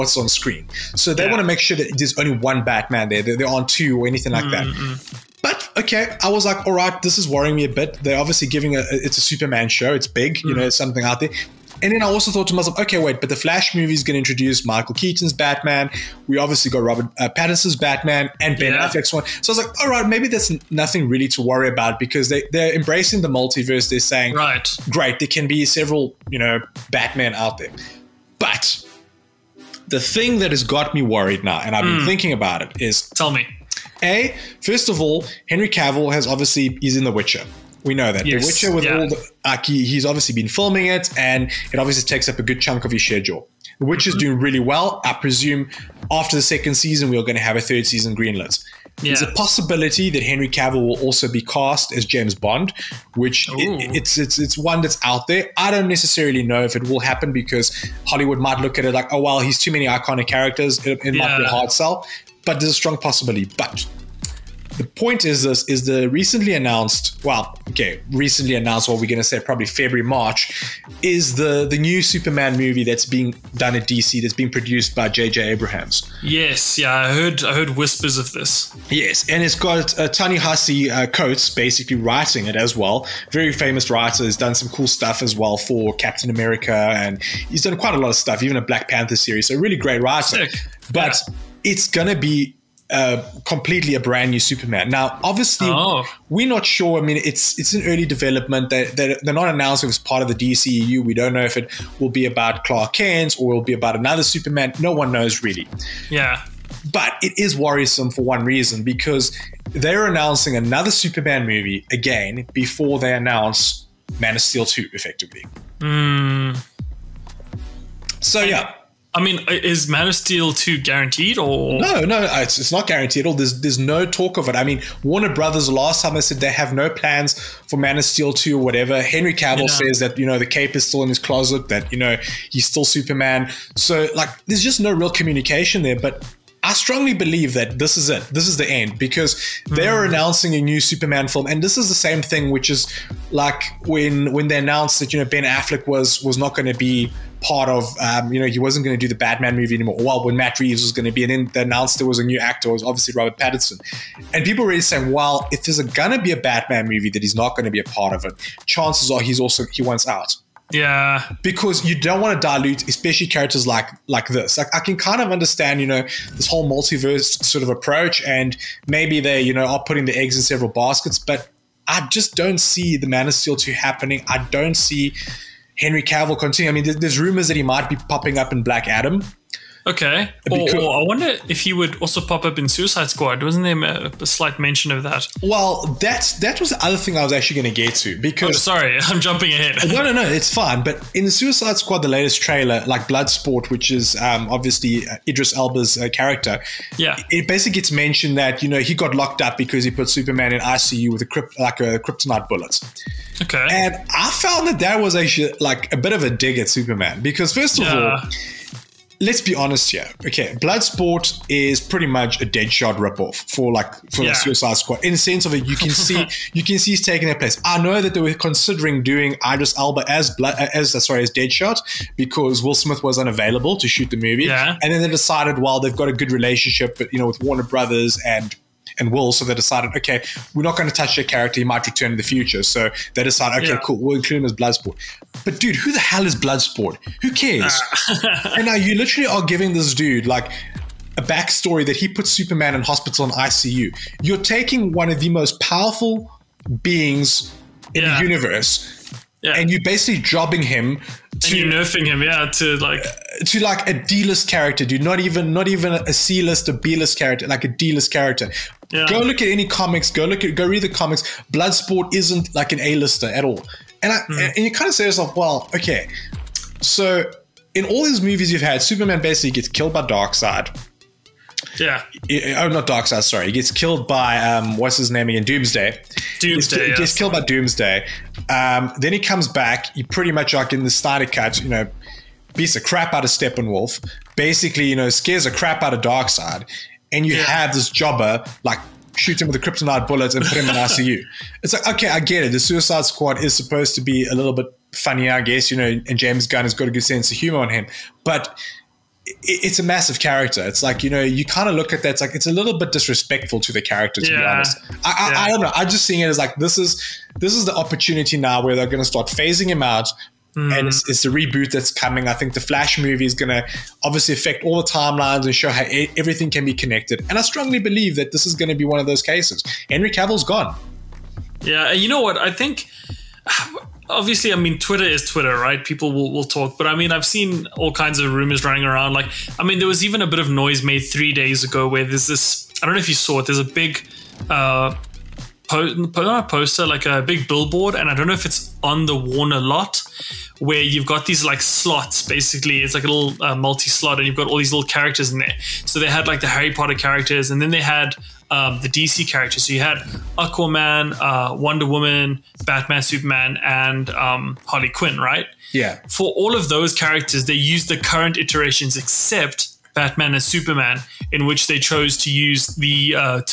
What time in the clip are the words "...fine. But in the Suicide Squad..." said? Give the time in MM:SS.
03:10.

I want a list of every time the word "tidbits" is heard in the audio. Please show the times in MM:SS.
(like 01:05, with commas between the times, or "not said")
not said.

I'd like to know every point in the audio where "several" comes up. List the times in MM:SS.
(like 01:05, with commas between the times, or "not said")
00:25, 02:50.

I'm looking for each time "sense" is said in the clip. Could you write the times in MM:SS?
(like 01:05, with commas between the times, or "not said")
03:35, 04:57.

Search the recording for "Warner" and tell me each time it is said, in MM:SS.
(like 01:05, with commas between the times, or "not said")
02:05, 03:47, 05:39.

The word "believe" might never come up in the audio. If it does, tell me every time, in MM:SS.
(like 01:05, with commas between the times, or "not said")
02:17, 05:17.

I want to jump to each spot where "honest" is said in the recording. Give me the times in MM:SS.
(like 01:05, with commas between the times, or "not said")
03:29, 05:04.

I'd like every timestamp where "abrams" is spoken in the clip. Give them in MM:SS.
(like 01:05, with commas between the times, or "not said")
01:15.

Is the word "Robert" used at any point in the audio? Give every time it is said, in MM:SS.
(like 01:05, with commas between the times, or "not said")
00:16, 02:33.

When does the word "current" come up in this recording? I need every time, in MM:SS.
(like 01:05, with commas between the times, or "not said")
05:57.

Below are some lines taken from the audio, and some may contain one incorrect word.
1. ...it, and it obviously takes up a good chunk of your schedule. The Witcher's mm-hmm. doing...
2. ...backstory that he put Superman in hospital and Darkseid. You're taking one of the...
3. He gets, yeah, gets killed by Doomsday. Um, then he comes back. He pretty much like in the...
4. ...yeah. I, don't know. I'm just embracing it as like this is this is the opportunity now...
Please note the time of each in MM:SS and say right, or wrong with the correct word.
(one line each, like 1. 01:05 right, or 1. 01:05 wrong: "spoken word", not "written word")
1. 00:40 right
2. 04:01 wrong: "ICU", not "Darkseid"
3. 04:36 right
4. 05:05 wrong: "seeing", not "embracing".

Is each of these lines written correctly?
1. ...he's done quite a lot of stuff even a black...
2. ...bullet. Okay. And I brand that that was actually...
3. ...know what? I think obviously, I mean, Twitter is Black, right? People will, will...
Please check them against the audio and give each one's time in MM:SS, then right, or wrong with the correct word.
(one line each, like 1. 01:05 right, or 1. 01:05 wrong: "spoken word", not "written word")
1. 01:27 right
2. 03:22 wrong: "found", not "brand"
3. 05:22 wrong: "Twitter", not "Black".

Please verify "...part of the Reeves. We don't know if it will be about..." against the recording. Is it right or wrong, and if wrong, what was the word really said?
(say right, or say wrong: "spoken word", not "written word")
wrong: "DCEU", not "Reeves".